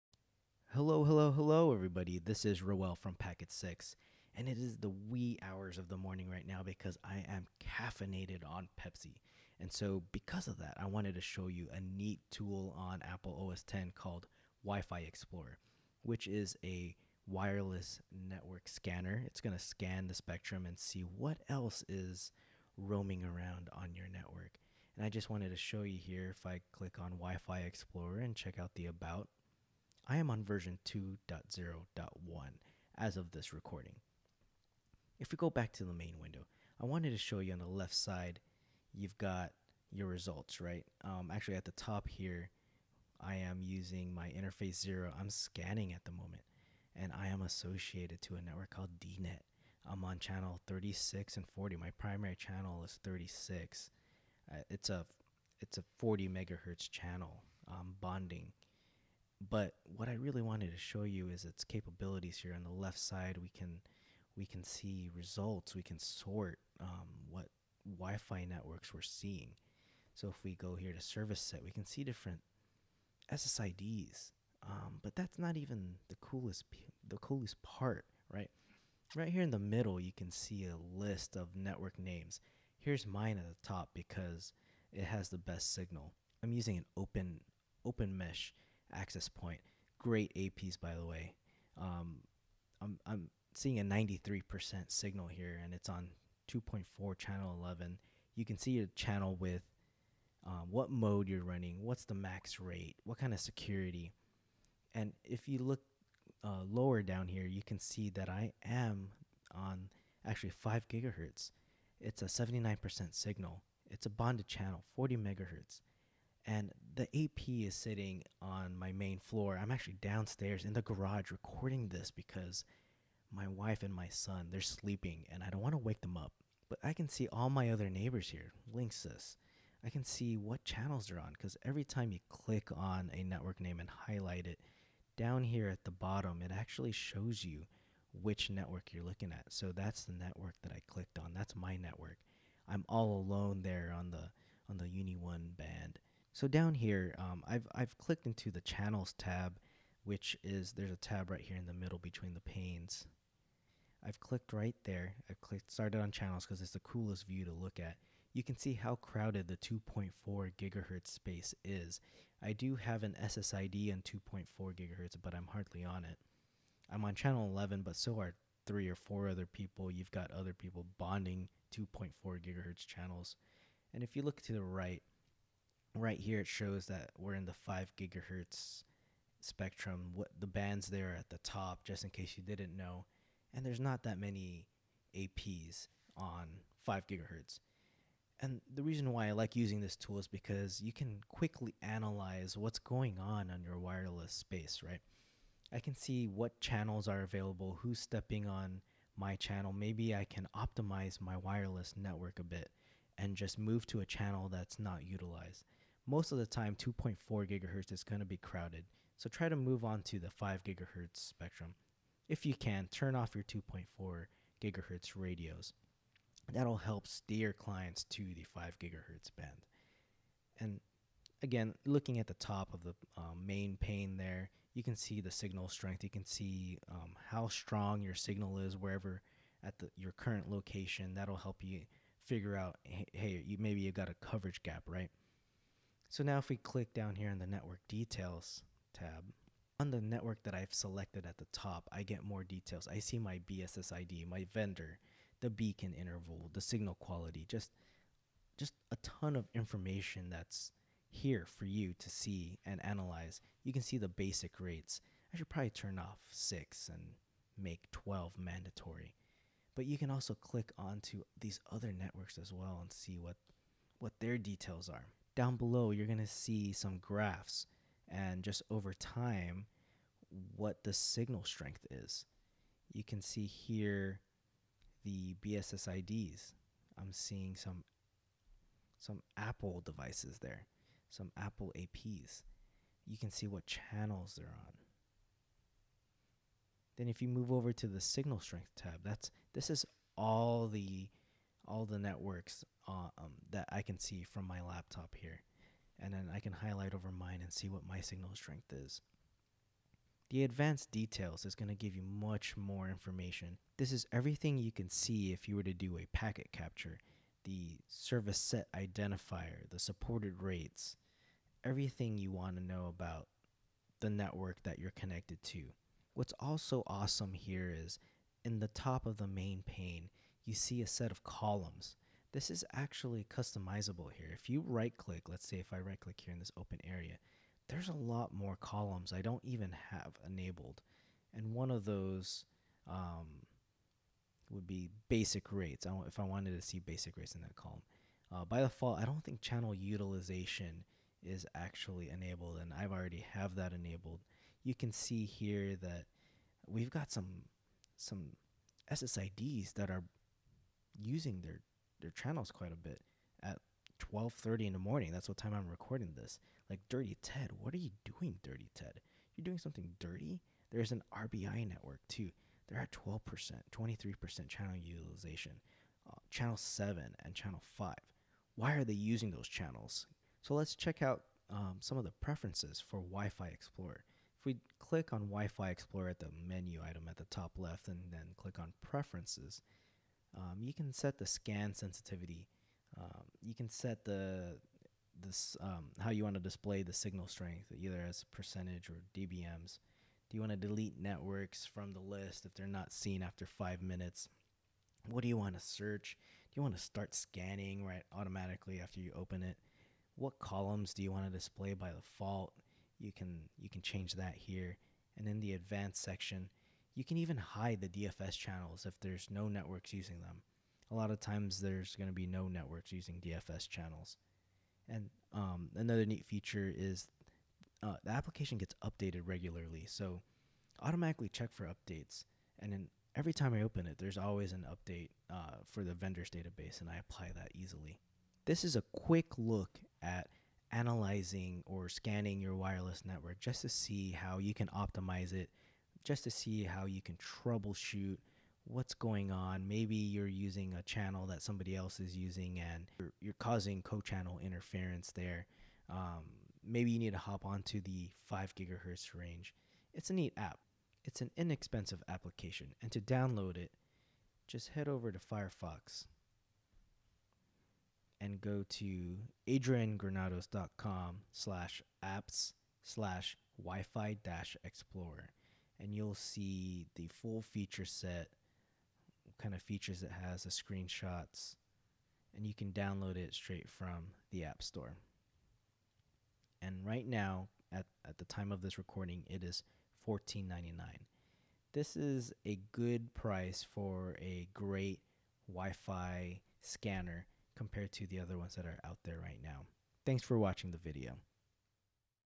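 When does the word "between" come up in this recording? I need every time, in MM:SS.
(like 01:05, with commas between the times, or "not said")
02:31.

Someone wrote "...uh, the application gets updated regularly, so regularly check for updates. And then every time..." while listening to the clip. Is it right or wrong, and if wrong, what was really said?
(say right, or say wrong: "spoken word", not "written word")
wrong: "automatically", not "regularly".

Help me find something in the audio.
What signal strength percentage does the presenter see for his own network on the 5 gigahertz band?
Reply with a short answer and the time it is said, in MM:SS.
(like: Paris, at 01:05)
79%, at 01:52.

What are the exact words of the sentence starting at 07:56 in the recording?
And right now, at, at the time of this recording, it is $14.99.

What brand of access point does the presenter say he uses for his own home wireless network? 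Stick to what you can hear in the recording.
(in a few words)
Open Mesh.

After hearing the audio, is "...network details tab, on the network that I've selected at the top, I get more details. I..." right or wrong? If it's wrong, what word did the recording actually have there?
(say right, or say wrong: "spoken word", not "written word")
right.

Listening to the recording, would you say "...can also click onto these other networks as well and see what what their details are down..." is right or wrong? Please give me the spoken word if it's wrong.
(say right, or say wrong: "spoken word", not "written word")
right.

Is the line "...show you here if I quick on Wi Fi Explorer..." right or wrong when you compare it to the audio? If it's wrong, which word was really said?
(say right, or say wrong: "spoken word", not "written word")
wrong: "click", not "quick".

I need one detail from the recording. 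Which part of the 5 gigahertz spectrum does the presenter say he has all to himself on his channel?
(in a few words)
UNII-1 band.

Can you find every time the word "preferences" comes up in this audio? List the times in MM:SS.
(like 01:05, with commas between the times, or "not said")
06:12, 06:18.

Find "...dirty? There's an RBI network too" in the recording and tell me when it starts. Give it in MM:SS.
05:59.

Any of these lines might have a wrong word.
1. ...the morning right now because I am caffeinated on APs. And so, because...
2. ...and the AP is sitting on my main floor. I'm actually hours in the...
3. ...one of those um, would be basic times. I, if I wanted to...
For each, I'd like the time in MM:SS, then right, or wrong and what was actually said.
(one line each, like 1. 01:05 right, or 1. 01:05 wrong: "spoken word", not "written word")
1. 00:05 wrong: "Pepsi", not "APs"
2. 01:56 wrong: "downstairs", not "hours"
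3. 05:31 wrong: "rates", not "times".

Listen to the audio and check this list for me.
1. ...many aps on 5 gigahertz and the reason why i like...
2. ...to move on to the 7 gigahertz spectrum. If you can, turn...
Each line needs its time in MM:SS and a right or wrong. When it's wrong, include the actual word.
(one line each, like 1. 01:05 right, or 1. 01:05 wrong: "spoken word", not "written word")
1. 03:04 right
2. 03:29 wrong: "5", not "7".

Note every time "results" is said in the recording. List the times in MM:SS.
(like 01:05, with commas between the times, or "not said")
00:40, 01:05.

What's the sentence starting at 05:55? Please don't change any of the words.
That's what time I'm recording this.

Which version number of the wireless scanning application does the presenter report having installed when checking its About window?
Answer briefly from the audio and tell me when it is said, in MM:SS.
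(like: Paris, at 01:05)
2.0.1, at 00:30.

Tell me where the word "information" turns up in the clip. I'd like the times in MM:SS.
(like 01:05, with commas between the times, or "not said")
04:09, 05:02.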